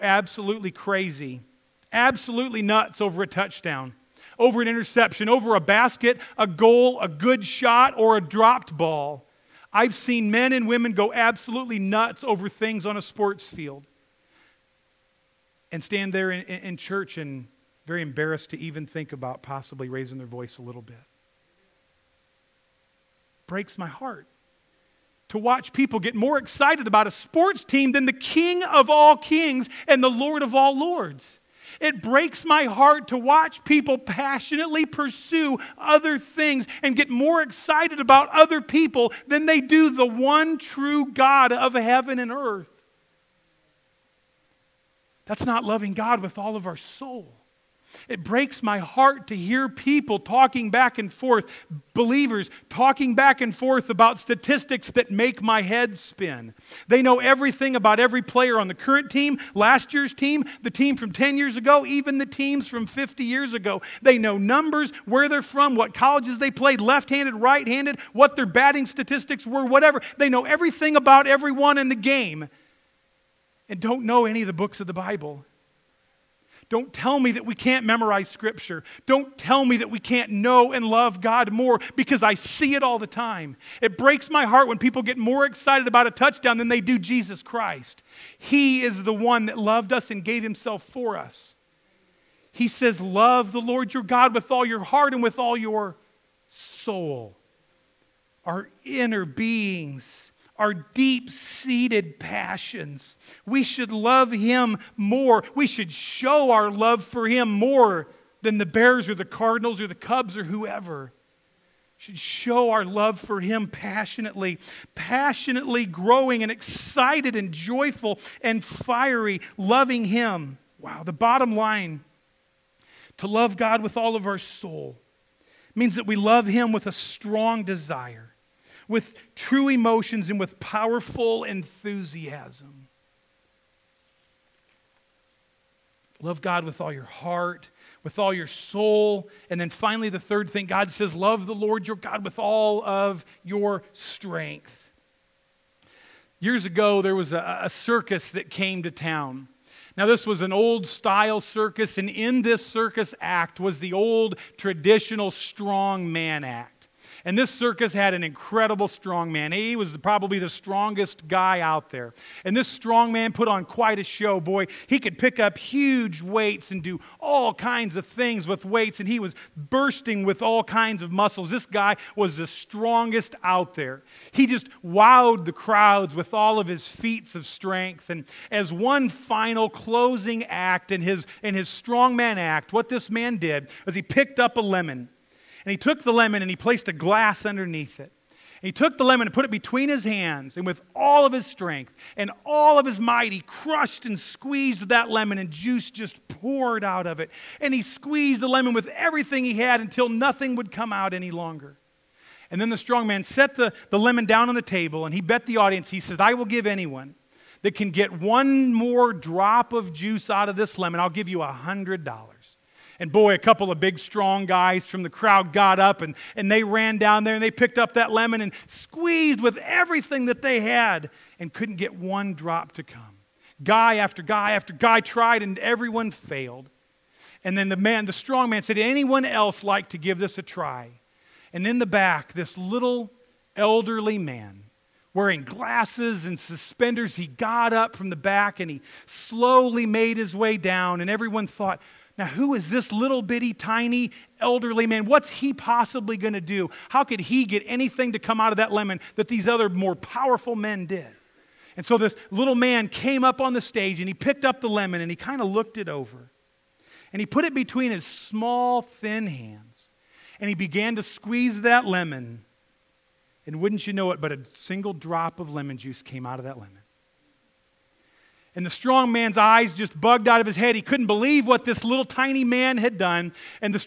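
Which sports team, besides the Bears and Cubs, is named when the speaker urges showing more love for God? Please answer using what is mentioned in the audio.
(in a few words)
Cardinals.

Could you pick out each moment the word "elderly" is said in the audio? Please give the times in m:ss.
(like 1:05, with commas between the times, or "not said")
3:53, 4:04.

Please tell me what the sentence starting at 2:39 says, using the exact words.
He was probably the strongest guy out there.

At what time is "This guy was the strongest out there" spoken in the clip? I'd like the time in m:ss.
2:51.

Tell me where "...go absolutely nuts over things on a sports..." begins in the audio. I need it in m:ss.
0:10.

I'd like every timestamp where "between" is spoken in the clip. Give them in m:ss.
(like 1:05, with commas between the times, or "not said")
3:09, 4:17.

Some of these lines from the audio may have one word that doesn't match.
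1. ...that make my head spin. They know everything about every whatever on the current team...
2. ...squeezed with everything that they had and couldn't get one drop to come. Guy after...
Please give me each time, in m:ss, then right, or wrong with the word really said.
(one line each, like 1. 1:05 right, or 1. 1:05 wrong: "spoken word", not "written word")
1. 0:54 wrong: "player", not "whatever"
2. 3:38 right.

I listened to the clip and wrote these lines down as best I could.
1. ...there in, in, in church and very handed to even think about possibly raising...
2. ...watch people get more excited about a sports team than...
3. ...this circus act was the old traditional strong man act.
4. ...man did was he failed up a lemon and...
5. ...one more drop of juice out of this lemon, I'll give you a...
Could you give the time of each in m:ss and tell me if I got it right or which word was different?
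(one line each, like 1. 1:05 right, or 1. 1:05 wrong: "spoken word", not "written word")
1. 0:16 wrong: "embarrassed", not "handed"
2. 0:25 right
3. 2:32 right
4. 3:03 wrong: "picked", not "failed"
5. 3:28 right.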